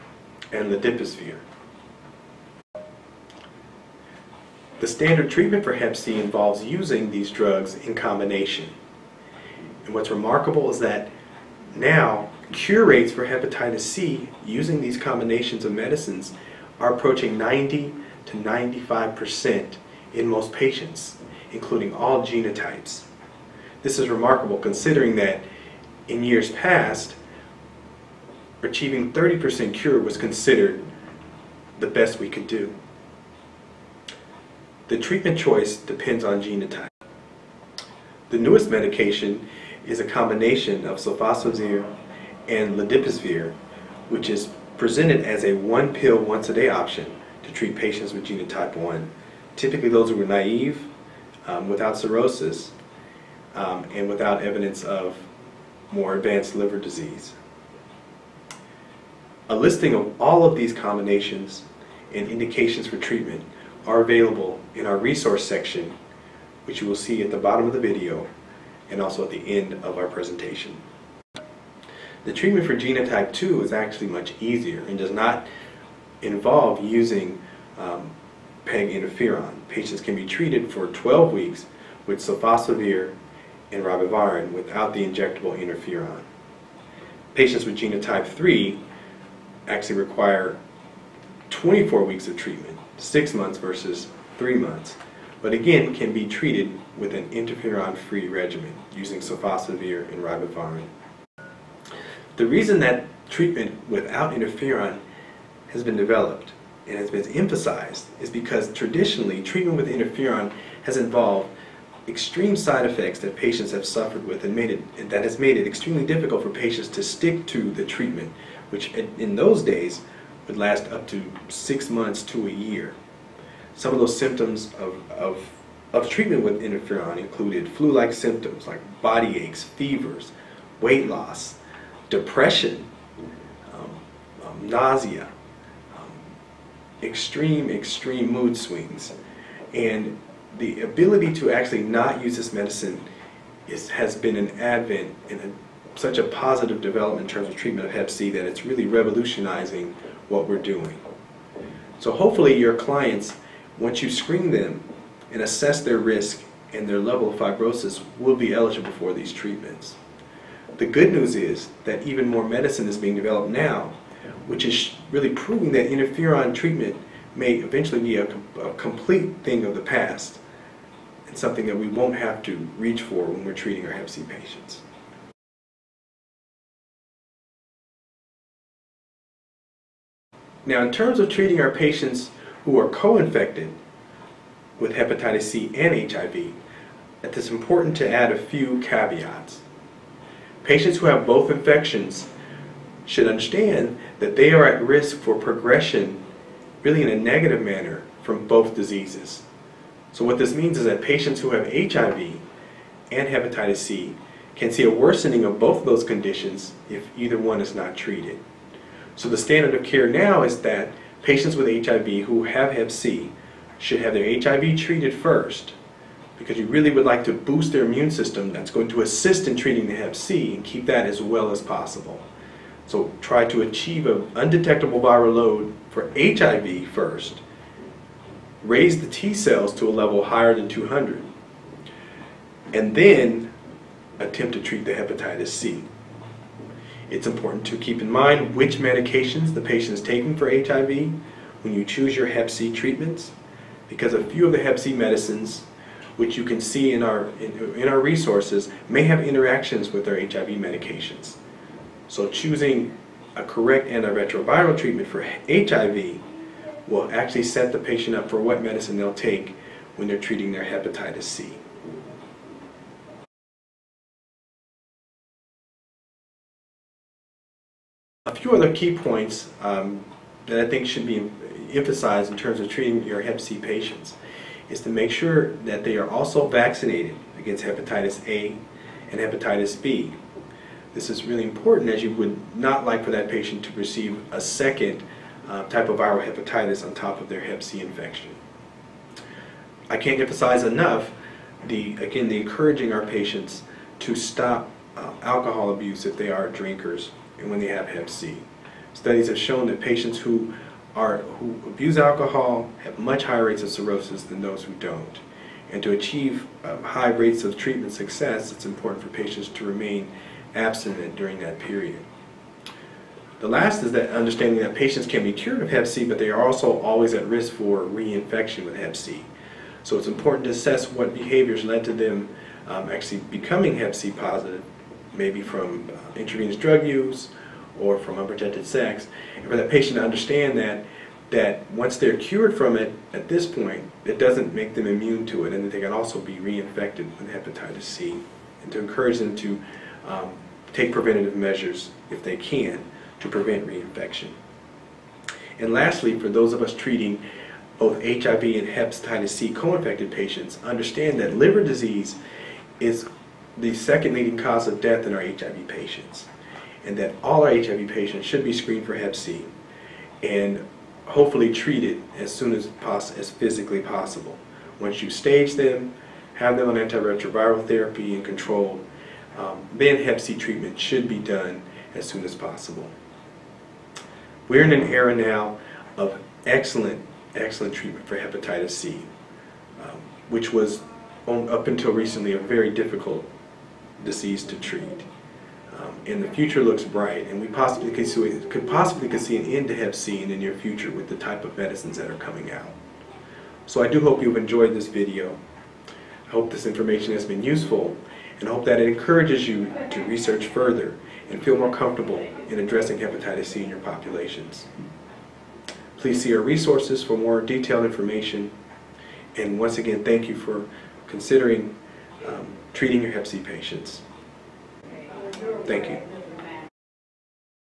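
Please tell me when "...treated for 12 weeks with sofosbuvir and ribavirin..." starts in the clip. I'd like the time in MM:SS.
01:20.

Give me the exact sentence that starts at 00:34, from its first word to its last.
The treatment choice depends on genotype.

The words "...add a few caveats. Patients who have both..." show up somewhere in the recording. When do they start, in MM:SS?
03:08.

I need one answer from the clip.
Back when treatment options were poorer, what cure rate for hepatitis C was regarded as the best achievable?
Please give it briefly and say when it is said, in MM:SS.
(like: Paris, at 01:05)
30%, at 00:29.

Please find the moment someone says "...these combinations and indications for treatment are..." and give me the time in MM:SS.
01:00.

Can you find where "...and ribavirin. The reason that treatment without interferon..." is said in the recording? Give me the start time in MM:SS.
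01:40.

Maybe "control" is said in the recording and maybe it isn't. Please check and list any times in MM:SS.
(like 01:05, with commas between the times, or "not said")
06:08.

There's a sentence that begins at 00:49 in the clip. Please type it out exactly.
Typically those who are naive um, without cirrhosis um, and without evidence of more advanced liver disease.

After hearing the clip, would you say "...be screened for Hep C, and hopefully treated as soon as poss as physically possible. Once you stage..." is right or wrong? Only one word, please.
right.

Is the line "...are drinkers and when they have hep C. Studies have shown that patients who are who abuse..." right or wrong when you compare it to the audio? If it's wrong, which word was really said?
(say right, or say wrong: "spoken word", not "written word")
right.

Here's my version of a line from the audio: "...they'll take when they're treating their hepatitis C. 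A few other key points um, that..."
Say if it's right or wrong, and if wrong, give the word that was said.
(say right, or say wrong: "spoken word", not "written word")
right.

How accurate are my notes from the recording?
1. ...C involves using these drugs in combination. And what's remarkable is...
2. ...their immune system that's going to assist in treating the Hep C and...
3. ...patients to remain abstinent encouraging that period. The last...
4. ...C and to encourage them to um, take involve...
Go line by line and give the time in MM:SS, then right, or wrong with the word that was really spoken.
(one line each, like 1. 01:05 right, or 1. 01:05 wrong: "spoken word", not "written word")
1. 00:05 right
2. 03:37 right
3. 05:09 wrong: "during", not "encouraging"
4. 05:37 wrong: "preventative", not "involve".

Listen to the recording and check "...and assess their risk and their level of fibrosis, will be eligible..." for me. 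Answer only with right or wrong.
right.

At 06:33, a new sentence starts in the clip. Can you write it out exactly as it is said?
So I do hope you've enjoyed this video.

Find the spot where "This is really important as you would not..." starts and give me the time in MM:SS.
04:40.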